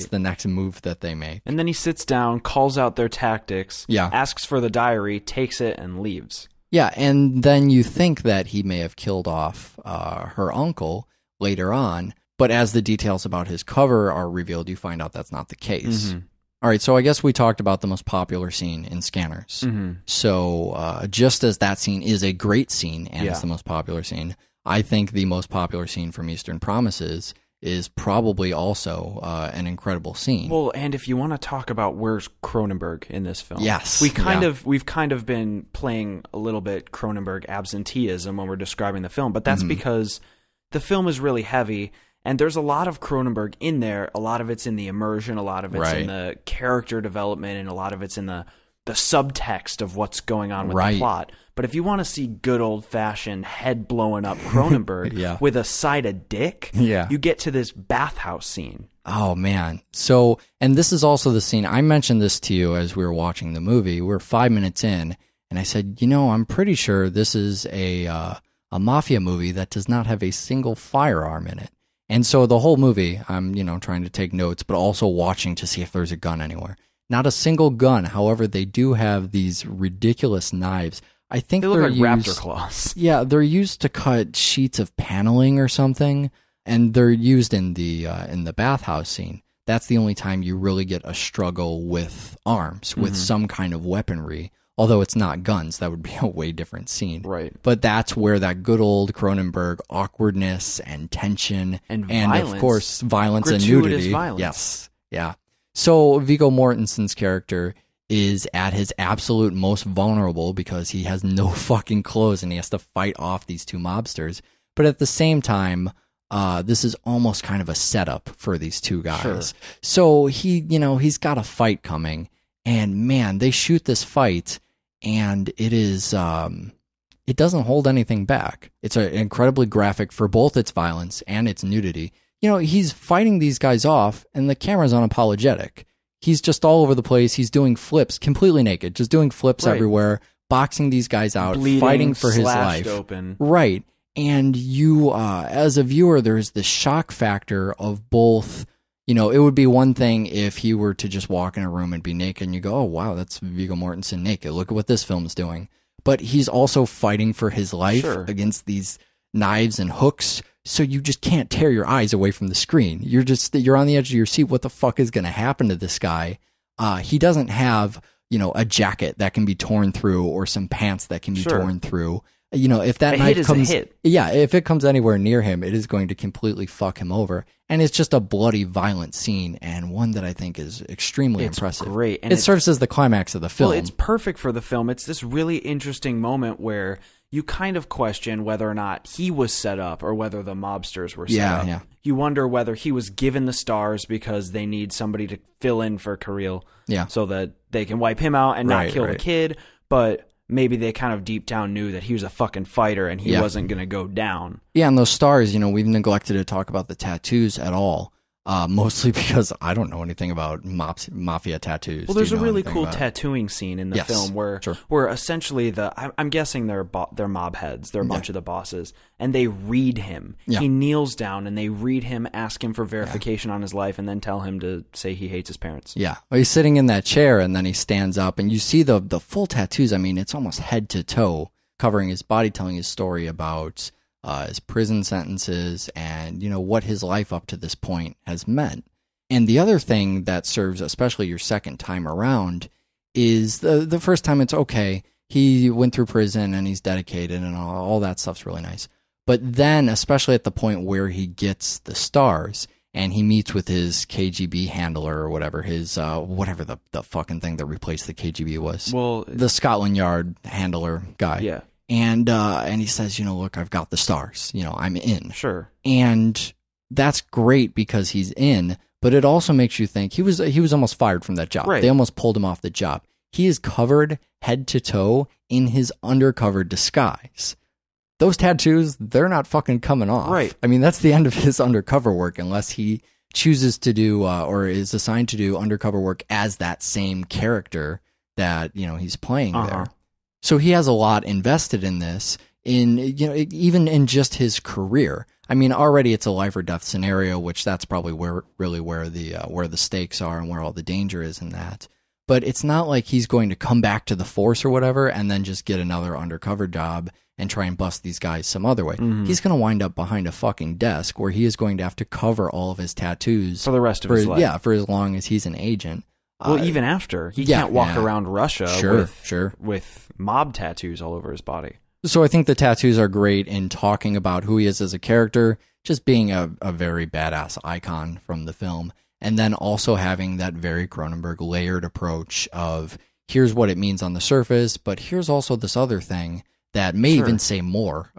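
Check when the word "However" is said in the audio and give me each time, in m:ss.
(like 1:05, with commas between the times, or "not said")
1:18.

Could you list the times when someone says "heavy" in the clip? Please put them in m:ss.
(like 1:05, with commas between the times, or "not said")
0:41.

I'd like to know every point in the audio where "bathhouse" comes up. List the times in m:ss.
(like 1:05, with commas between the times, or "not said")
0:57, 1:28.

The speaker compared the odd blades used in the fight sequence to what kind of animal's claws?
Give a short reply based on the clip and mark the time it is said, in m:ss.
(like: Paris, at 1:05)
Raptor claws, at 1:22.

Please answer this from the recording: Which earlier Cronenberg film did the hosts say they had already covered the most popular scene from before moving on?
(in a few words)
Scanners.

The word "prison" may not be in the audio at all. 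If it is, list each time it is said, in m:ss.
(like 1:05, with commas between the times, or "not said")
3:54, 4:06.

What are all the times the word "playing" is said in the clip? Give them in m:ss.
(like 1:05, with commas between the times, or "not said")
0:35, 4:49.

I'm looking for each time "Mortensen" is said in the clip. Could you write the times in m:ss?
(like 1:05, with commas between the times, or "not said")
1:46, 2:33.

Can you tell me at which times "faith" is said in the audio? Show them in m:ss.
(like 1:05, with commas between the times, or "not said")
not said.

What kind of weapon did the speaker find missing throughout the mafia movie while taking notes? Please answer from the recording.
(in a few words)
Firearm.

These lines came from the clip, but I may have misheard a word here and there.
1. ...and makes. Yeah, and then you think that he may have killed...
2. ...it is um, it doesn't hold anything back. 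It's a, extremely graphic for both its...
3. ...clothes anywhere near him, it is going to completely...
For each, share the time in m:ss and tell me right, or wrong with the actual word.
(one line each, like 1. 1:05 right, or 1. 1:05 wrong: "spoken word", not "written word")
1. 0:05 wrong: "leaves", not "makes"
2. 2:05 wrong: "incredibly", not "extremely"
3. 2:54 wrong: "comes", not "clothes".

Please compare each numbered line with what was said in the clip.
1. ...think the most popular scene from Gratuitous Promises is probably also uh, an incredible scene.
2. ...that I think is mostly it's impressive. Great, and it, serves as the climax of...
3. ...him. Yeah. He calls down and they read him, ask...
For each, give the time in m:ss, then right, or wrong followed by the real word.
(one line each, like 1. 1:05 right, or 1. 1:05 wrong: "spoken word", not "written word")
1. 0:24 wrong: "Eastern", not "Gratuitous"
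2. 3:00 wrong: "extremely", not "mostly"
3. 3:39 wrong: "kneels", not "calls".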